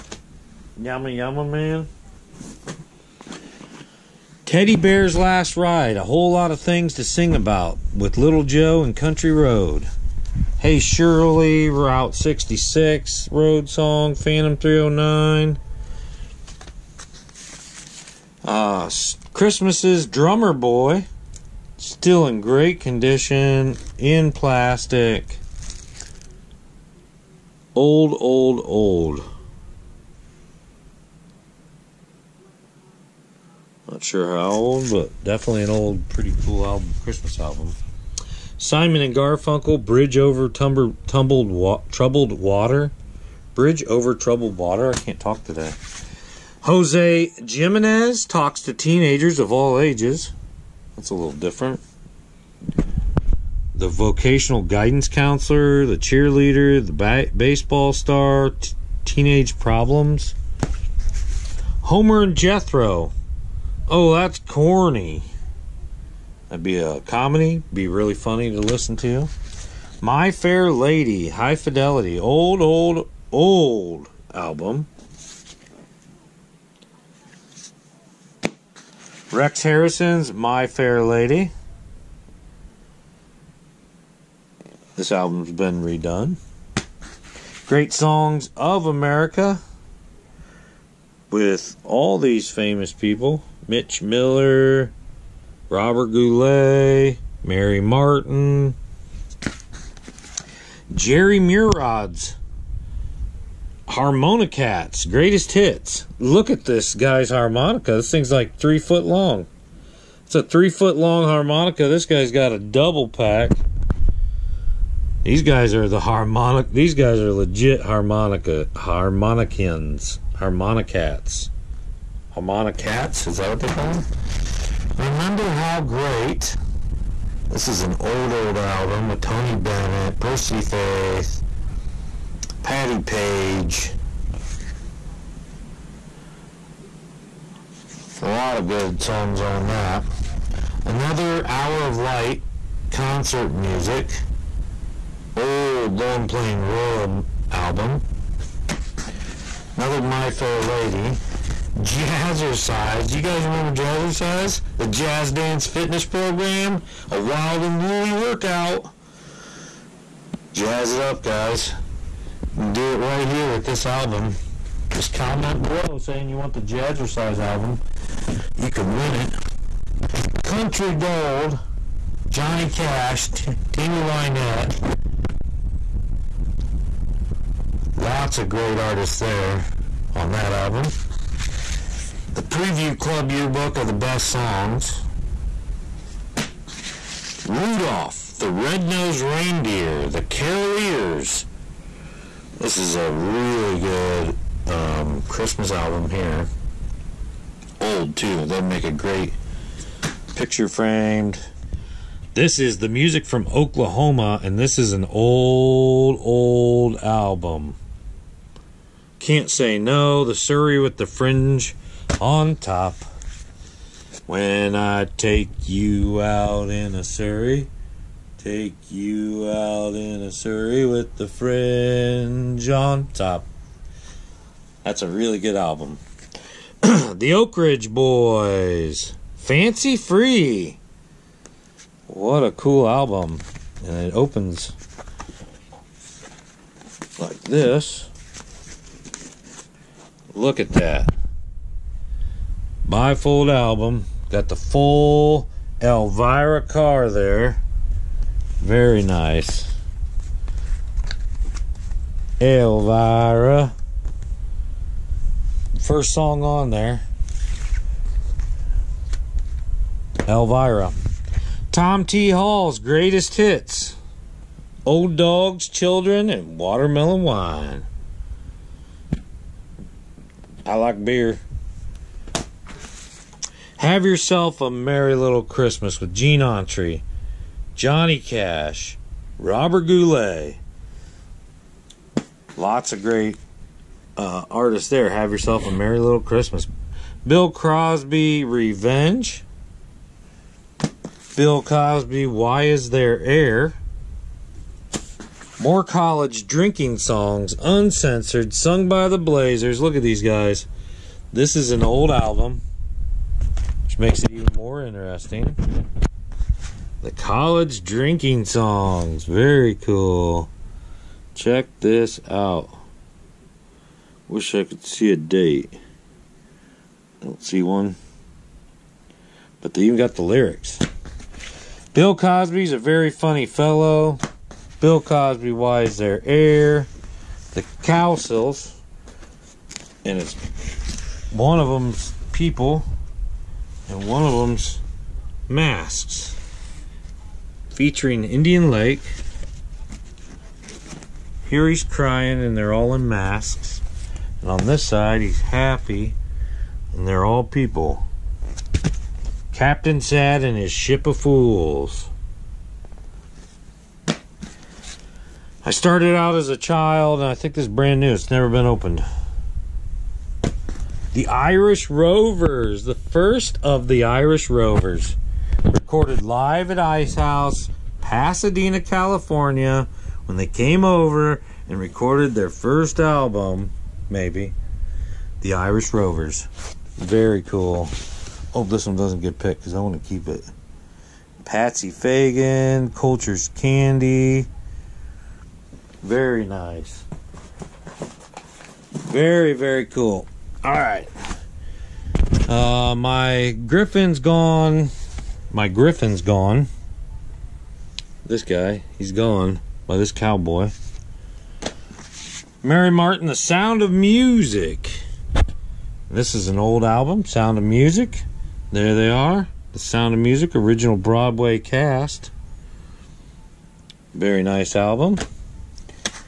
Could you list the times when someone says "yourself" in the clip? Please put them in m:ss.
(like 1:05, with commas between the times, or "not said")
4:34, 4:45.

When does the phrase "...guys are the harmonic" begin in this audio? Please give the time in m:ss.
1:55.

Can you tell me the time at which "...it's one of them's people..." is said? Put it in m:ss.
5:30.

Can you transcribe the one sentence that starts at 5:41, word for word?
Here he's crying and they're all in masks.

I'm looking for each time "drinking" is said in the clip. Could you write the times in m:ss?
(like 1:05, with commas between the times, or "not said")
4:56, 5:07.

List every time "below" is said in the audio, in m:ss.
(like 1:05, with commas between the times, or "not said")
2:45.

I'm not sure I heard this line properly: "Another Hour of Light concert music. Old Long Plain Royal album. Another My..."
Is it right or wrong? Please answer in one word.
right.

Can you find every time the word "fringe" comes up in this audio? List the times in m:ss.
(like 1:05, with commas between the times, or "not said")
3:31, 3:41.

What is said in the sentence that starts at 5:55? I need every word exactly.
I started out as a child and I think this is brand new.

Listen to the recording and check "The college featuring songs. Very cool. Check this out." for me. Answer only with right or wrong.
wrong.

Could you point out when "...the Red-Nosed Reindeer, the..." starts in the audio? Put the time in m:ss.
3:08.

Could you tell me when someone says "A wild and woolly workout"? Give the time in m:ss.
2:37.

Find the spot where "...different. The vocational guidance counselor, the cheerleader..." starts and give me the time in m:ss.
0:51.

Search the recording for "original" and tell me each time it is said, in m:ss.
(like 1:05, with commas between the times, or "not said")
6:50.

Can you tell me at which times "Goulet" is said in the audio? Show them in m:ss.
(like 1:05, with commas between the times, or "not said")
1:36, 4:39.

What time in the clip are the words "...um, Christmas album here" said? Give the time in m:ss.
3:14.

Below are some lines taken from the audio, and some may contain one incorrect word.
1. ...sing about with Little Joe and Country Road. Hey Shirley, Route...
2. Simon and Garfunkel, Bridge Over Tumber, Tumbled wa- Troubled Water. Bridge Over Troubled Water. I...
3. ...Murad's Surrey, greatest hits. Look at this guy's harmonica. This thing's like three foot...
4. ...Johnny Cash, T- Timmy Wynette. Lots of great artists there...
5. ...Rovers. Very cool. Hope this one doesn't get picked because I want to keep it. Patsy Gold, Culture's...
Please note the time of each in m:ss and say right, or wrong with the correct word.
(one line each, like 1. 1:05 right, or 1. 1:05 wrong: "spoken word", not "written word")
1. 0:07 right
2. 0:38 right
3. 1:41 wrong: "Harmonicats", not "Surrey"
4. 2:52 right
5. 6:15 wrong: "Fagan", not "Gold".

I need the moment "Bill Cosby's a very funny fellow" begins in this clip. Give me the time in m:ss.
5:21.